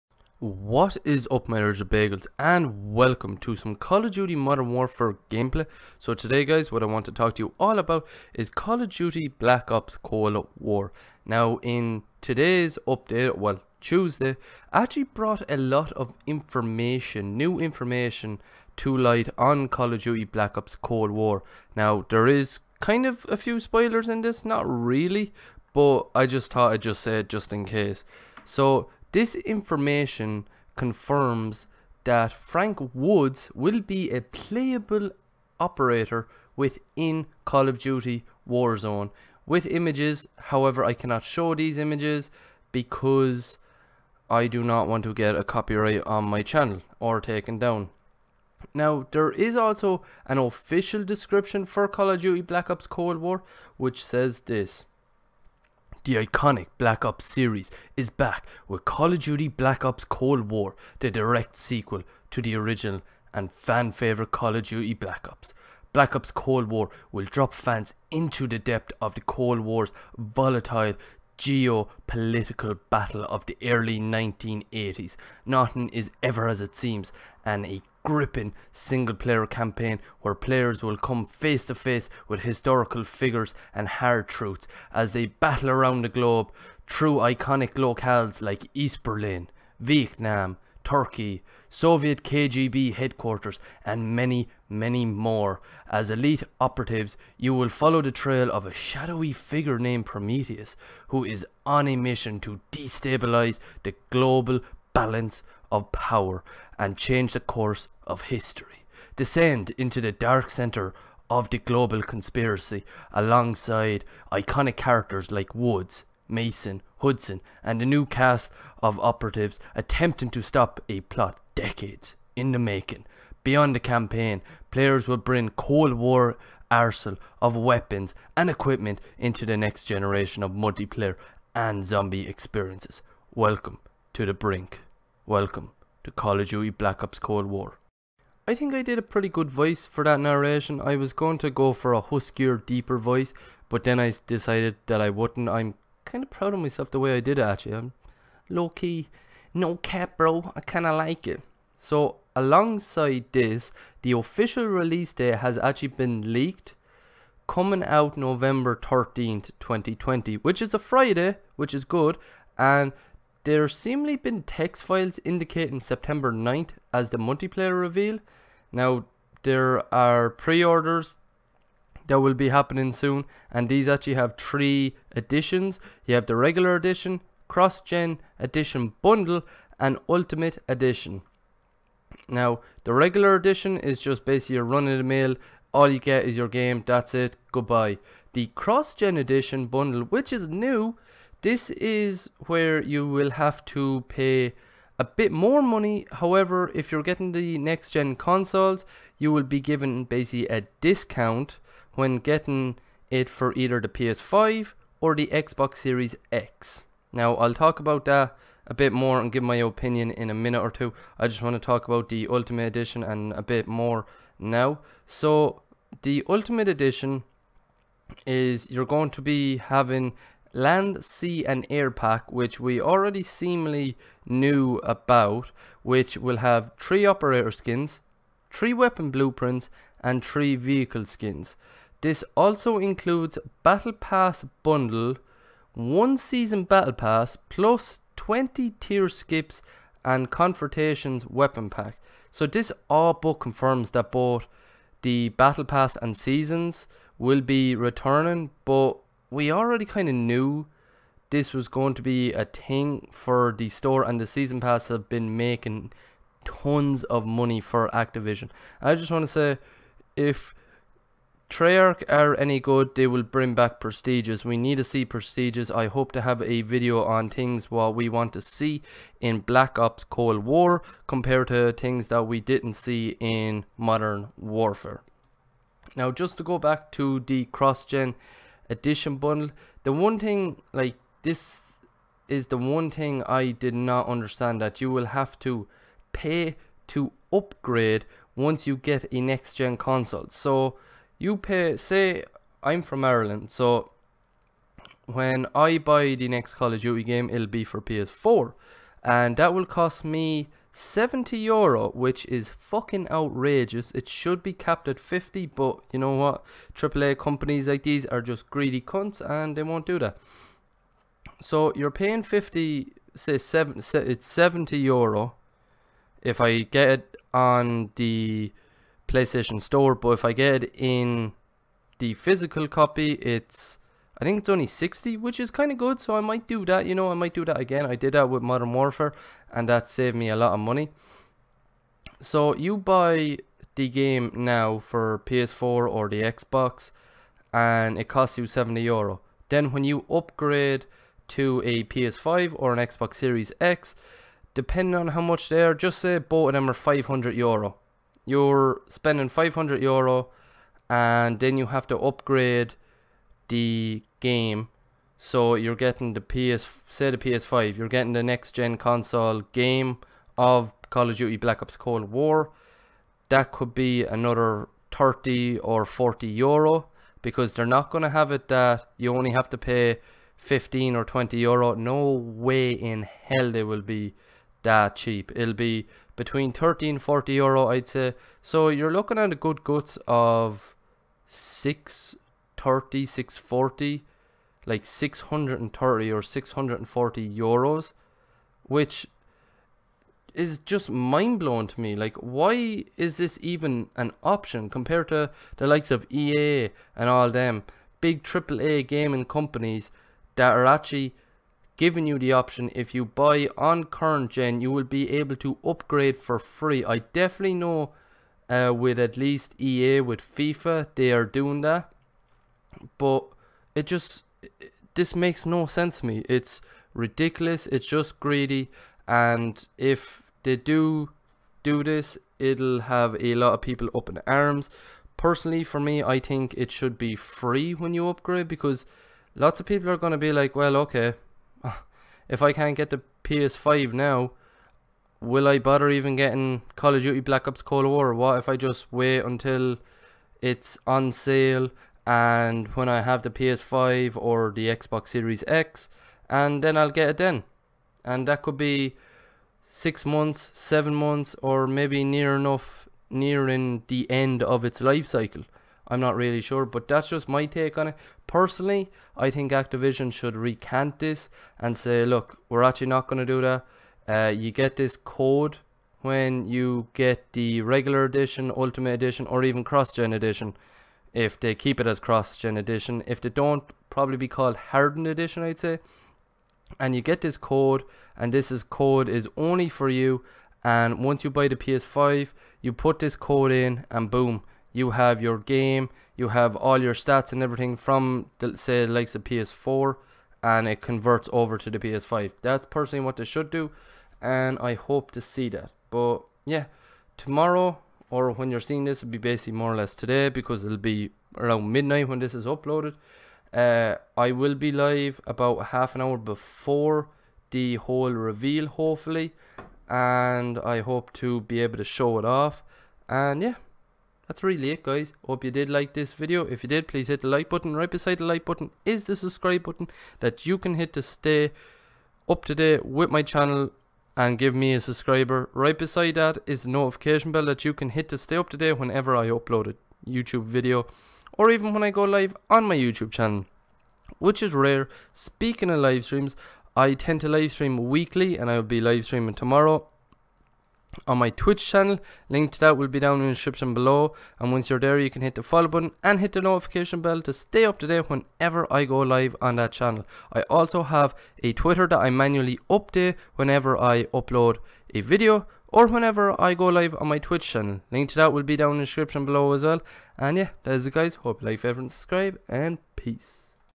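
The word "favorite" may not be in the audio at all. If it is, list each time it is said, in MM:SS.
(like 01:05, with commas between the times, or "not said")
01:03, 09:21.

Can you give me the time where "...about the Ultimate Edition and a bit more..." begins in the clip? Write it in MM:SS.
03:31.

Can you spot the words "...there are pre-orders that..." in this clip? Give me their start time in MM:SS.
02:49.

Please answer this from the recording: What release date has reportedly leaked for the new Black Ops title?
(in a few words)
November 13th, 2020.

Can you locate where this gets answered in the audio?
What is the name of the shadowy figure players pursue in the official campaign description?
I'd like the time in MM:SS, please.
01:40.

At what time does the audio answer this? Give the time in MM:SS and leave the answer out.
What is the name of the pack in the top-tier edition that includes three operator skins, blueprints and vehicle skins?
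03:40.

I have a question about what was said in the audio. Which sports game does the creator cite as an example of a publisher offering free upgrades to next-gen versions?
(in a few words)
FIFA.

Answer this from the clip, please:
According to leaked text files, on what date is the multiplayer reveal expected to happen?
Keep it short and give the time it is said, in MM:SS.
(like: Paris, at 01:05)
September 9th, at 02:45.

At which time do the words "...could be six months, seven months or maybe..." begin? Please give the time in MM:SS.
07:28.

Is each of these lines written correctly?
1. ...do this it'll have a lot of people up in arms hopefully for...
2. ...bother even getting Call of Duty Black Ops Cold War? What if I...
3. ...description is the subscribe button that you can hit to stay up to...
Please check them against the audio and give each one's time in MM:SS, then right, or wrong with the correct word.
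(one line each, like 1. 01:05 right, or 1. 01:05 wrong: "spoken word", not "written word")
1. 07:01 wrong: "personally", not "hopefully"
2. 07:15 right
3. 08:38 wrong: "button", not "description".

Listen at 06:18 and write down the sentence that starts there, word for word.
So you're looking at a good guts of 630, 640, like 630 or 640 euros, which is just mind blowing to me.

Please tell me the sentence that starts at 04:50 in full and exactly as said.
So, you pay, say I'm from Ireland, so when I buy the next Call of Duty game, it'll be for PS4.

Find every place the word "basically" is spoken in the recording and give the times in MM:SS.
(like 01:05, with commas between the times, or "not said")
03:04, 03:20, 08:19.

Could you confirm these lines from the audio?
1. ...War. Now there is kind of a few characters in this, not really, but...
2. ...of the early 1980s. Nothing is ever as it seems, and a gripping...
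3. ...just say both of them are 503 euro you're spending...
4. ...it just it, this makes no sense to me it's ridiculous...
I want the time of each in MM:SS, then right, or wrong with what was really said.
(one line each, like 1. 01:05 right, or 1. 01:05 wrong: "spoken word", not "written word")
1. 00:21 wrong: "spoilers", not "characters"
2. 01:13 right
3. 05:45 wrong: "500", not "503"
4. 06:53 right.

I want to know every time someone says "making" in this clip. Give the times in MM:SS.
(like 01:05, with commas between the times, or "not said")
02:02, 04:15.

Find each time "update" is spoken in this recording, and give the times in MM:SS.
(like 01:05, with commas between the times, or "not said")
00:12, 09:12.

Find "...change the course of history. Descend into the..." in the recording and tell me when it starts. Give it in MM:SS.
01:46.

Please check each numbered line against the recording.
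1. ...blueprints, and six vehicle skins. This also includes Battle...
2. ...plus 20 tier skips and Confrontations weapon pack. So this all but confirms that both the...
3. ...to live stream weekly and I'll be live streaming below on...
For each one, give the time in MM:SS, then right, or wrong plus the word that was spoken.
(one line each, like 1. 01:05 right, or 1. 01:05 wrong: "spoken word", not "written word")
1. 03:49 wrong: "three", not "six"
2. 03:57 right
3. 08:57 wrong: "tomorrow", not "below".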